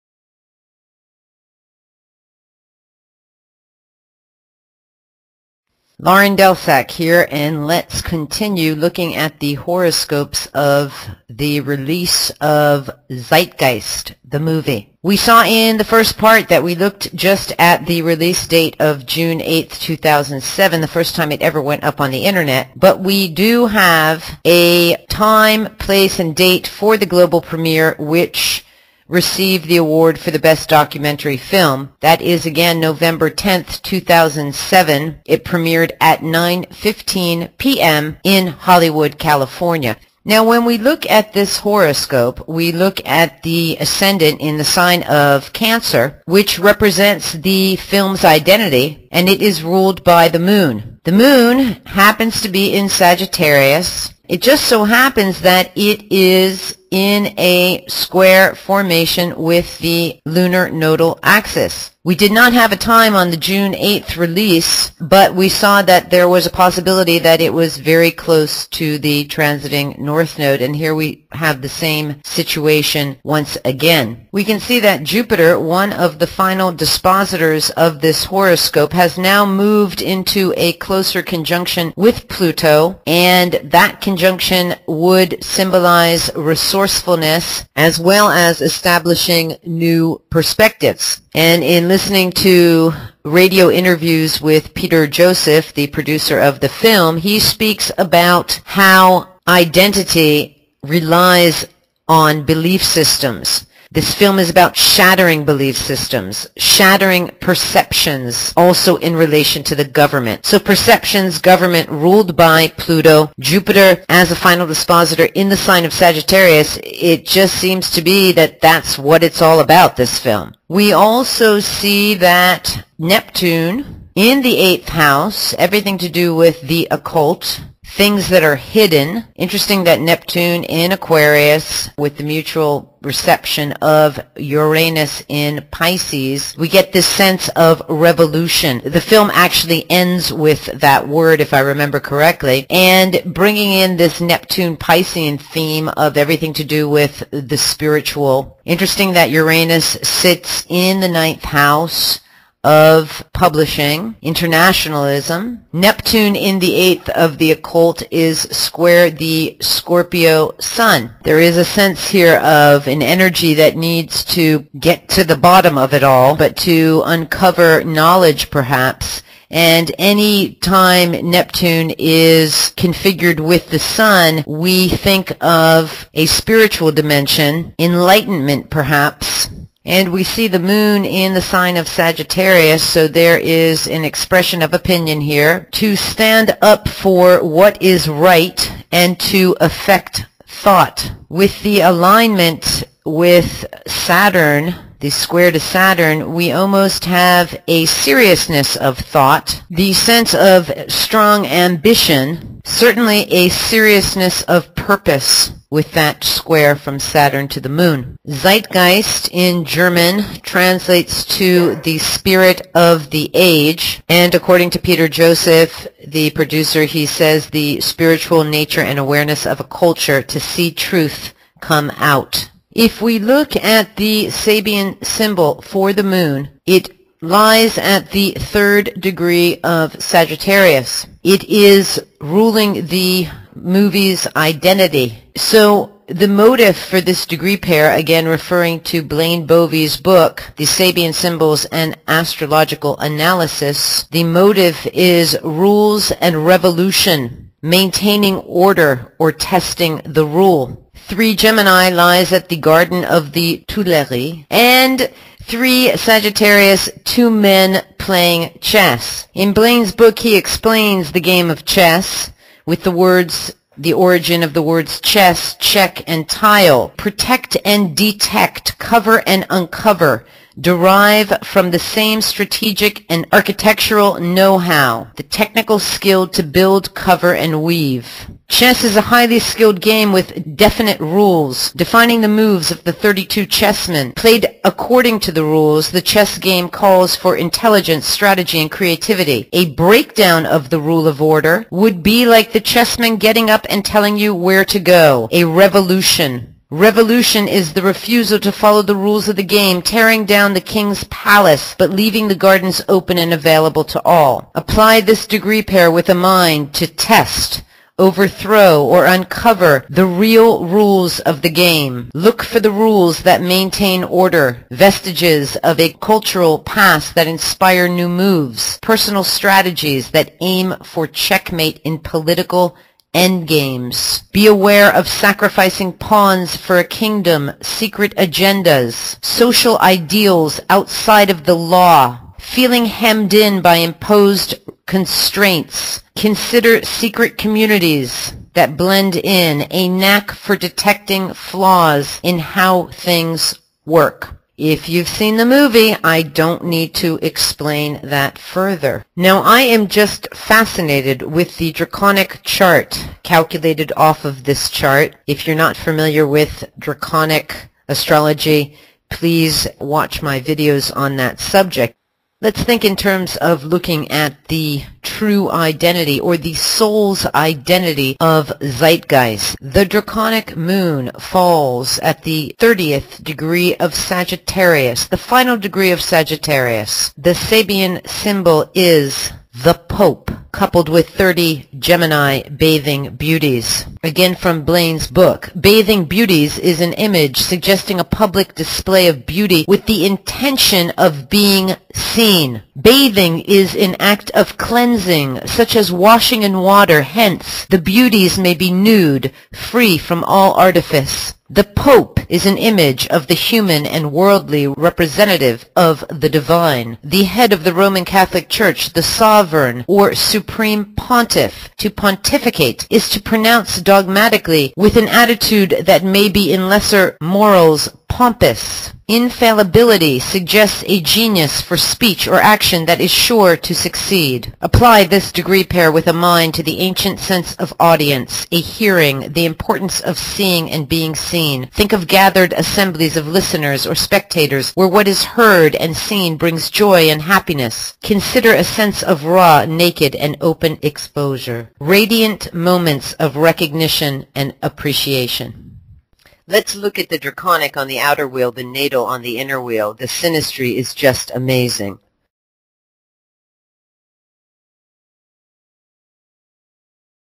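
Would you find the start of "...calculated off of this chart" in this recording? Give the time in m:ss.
5:53.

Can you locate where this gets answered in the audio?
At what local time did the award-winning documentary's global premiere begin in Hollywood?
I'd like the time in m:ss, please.
0:36.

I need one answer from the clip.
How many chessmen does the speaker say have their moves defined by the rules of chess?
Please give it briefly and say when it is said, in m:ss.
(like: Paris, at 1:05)
32, at 4:42.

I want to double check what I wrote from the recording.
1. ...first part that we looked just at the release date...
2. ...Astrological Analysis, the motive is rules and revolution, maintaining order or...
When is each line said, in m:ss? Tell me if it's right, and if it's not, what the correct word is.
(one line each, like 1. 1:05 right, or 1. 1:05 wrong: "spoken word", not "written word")
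1. 0:15 right
2. 4:02 right.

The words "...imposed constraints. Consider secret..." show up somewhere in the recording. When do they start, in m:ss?
5:33.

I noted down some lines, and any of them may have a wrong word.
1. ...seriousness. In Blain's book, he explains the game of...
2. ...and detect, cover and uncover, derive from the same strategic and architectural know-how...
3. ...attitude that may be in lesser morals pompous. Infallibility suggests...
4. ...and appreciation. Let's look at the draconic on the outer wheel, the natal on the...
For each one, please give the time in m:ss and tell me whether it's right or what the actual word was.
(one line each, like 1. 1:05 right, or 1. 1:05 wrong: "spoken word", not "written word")
1. 4:18 wrong: "chess", not "seriousness"
2. 4:27 right
3. 6:55 right
4. 7:24 right.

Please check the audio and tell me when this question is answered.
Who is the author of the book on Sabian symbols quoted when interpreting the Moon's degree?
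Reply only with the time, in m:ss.
3:59.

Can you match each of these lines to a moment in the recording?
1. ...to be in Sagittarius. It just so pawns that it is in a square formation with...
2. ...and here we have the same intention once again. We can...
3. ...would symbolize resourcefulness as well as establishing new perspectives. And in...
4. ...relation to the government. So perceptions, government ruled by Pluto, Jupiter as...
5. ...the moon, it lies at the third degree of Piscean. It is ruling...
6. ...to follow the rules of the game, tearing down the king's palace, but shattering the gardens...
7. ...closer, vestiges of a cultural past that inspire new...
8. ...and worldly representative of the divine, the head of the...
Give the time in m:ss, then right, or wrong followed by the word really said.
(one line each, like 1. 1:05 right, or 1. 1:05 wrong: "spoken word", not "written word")
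1. 0:52 wrong: "happens", not "pawns"
2. 1:10 wrong: "situation", not "intention"
3. 1:24 right
4. 1:49 right
5. 3:45 wrong: "Sagittarius", not "Piscean"
6. 4:58 wrong: "leaving", not "shattering"
7. 5:14 wrong: "order", not "closer"
8. 6:43 right.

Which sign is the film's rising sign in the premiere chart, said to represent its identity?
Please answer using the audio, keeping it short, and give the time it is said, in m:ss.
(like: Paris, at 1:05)
Cancer, at 0:45.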